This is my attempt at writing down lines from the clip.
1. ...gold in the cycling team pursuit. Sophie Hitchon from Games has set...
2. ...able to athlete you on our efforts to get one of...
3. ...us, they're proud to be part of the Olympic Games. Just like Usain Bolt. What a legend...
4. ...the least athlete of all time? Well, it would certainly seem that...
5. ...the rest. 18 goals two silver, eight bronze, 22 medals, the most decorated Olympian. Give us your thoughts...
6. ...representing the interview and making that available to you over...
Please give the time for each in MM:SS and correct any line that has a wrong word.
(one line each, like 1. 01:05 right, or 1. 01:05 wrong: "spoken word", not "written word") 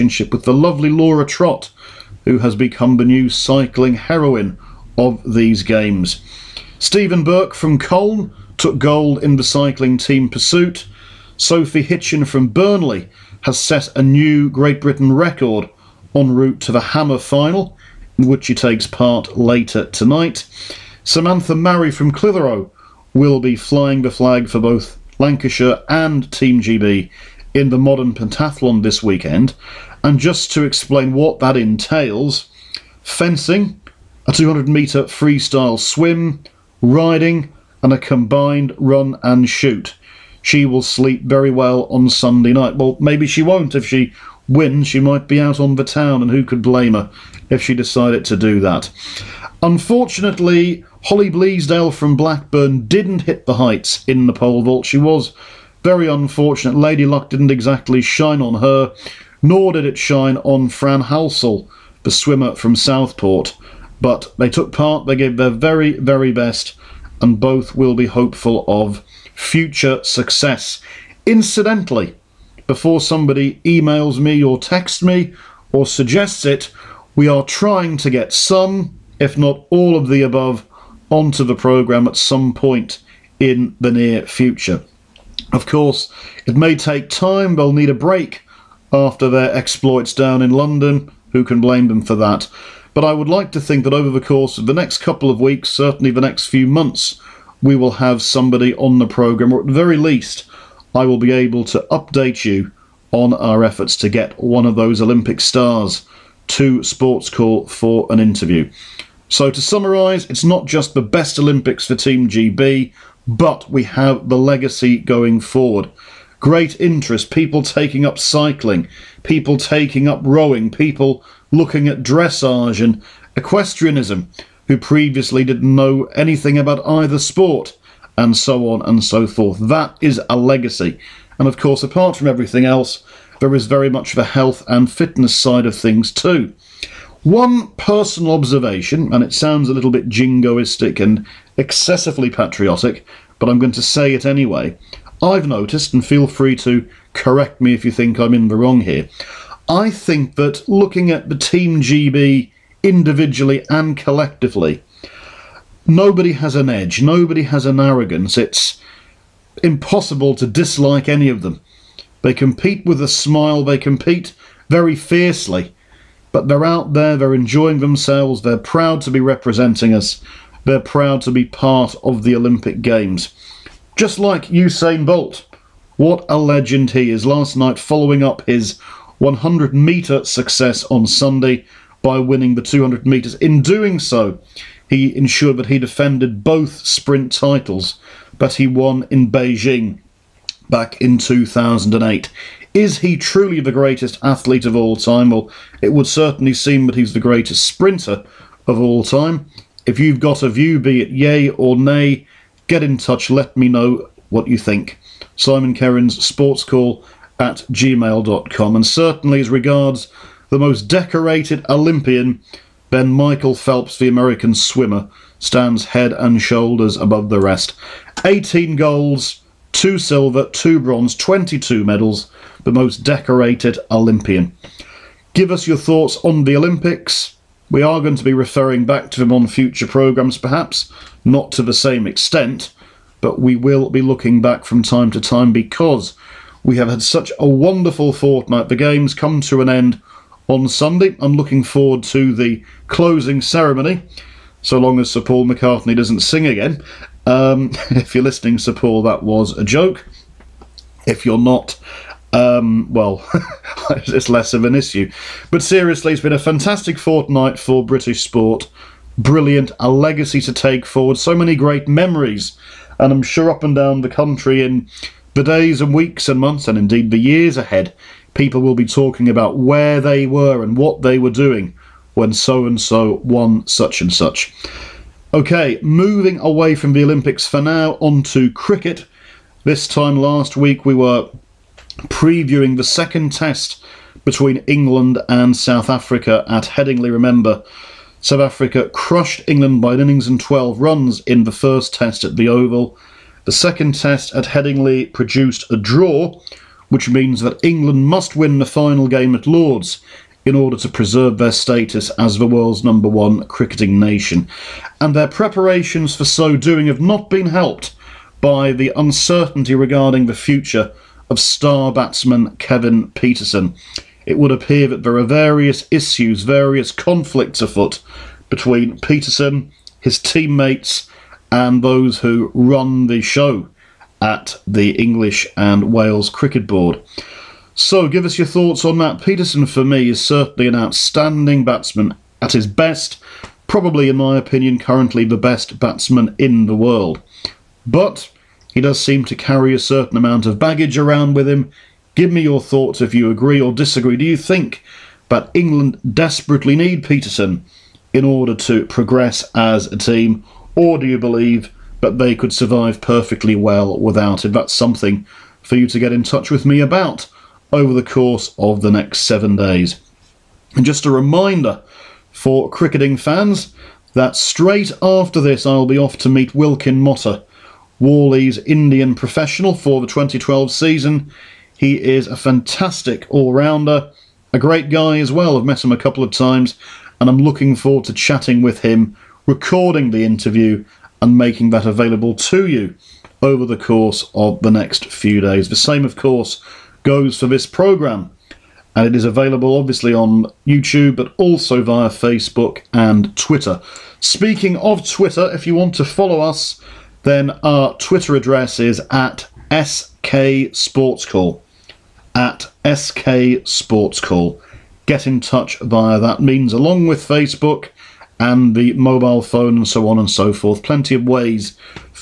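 1. 00:08 wrong: "Burnley", not "Games"
2. 01:41 wrong: "update", not "athlete"
3. 02:49 right
4. 03:13 wrong: "greatest", not "least"
5. 03:37 wrong: "two", not "eight"
6. 06:19 wrong: "recording", not "representing".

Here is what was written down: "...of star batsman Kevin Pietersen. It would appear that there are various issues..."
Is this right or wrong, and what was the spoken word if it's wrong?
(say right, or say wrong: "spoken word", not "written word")
right.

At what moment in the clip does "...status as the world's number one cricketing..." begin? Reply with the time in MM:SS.
05:01.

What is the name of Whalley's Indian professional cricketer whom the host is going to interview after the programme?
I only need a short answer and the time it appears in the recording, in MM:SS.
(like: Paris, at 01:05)
Wilkin Mota, at 06:06.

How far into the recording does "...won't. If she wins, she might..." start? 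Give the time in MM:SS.
00:43.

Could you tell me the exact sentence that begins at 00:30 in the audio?
And just to explain what that entails fencing, a 200 metre freestyle swim, riding, and a combined run and shoot.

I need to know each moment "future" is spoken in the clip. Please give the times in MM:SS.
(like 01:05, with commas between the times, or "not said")
01:09, 01:24, 03:49, 05:10.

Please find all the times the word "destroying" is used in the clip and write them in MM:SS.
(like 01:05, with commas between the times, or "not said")
not said.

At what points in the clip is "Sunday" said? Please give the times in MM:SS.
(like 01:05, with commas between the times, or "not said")
00:42, 03:01, 04:00.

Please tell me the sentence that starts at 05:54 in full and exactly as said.
That's something for you to get in touch with me about over the course of the next seven days.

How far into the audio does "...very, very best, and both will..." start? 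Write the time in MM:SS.
01:05.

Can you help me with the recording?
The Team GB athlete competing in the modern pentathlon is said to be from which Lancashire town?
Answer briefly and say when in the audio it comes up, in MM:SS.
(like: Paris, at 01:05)
Clitheroe, at 00:22.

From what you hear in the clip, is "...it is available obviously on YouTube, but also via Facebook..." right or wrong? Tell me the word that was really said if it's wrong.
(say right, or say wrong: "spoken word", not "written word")
right.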